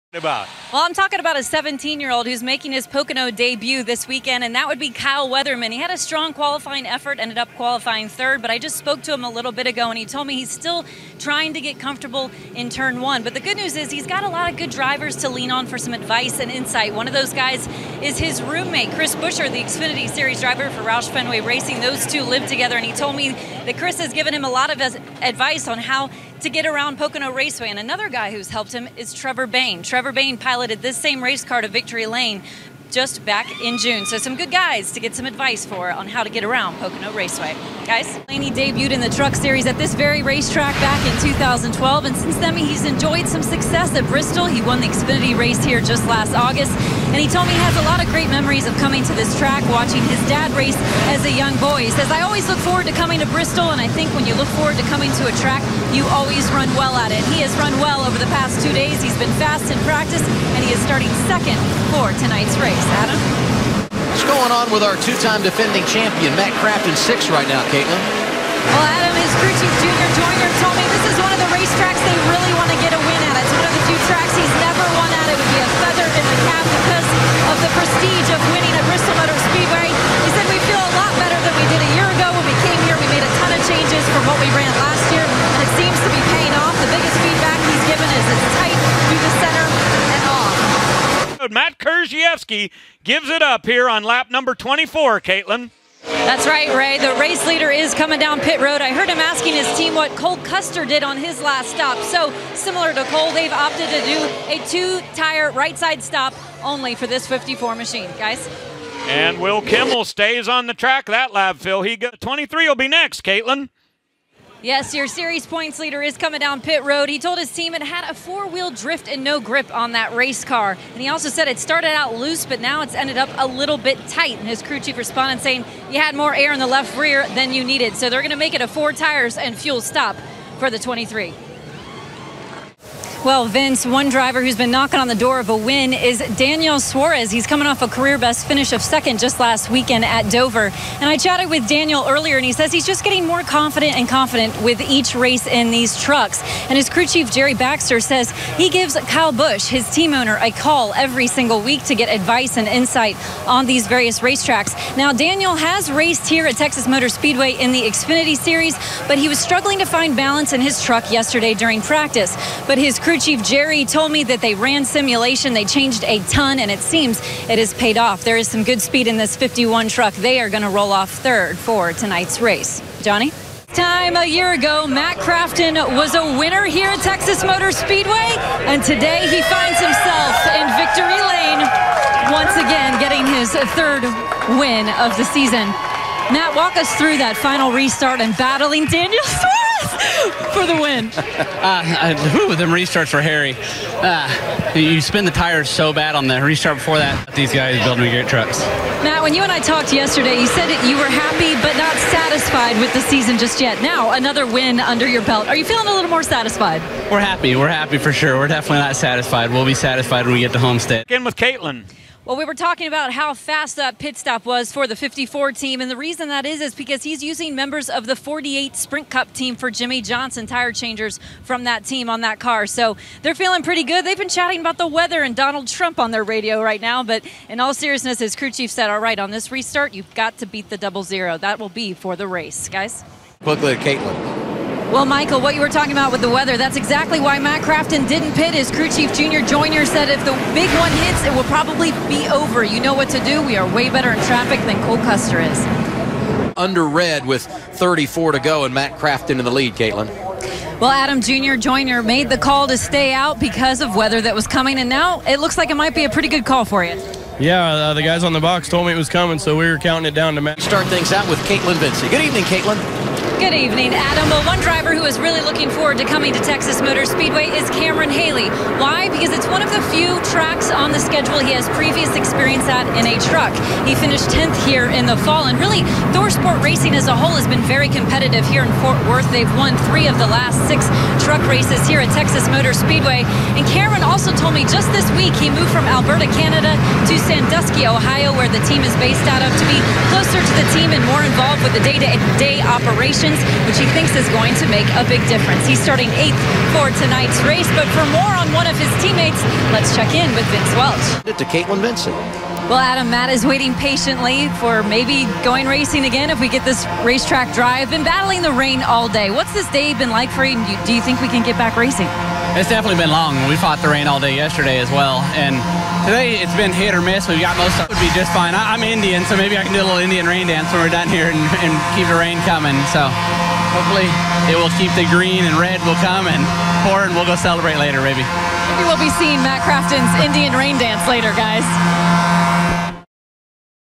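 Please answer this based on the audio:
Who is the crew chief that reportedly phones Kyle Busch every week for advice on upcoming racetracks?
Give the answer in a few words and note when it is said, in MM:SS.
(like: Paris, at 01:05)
Jerry Baxter, at 02:27.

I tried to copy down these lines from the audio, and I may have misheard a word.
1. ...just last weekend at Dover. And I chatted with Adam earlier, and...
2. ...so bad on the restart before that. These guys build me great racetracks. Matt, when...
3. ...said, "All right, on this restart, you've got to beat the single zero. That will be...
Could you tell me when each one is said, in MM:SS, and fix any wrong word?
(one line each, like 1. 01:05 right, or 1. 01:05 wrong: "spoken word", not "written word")
1. 02:19 wrong: "Daniel", not "Adam"
2. 03:15 wrong: "trucks", not "racetracks"
3. 03:48 wrong: "double", not "single".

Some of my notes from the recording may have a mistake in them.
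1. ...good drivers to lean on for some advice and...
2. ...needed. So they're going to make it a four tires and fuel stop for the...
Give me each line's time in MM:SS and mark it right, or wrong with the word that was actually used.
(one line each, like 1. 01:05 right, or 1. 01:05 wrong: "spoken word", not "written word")
1. 00:14 right
2. 02:07 right.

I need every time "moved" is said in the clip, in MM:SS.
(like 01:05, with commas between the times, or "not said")
04:45.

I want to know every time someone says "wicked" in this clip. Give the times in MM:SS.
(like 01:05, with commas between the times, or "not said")
not said.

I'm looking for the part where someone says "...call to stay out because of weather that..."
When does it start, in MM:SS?
04:12.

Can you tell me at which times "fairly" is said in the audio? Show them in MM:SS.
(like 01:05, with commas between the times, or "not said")
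not said.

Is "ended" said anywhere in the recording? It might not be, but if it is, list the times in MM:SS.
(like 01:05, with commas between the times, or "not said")
00:07, 02:02.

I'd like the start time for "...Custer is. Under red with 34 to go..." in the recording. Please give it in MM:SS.
04:04.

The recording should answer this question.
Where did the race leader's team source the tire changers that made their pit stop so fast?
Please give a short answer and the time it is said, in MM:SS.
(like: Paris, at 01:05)
48 Sprint Cup team, at 03:38.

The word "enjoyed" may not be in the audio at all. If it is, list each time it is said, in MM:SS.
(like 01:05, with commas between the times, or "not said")
00:42.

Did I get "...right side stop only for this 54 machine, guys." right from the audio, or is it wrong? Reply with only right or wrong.
right.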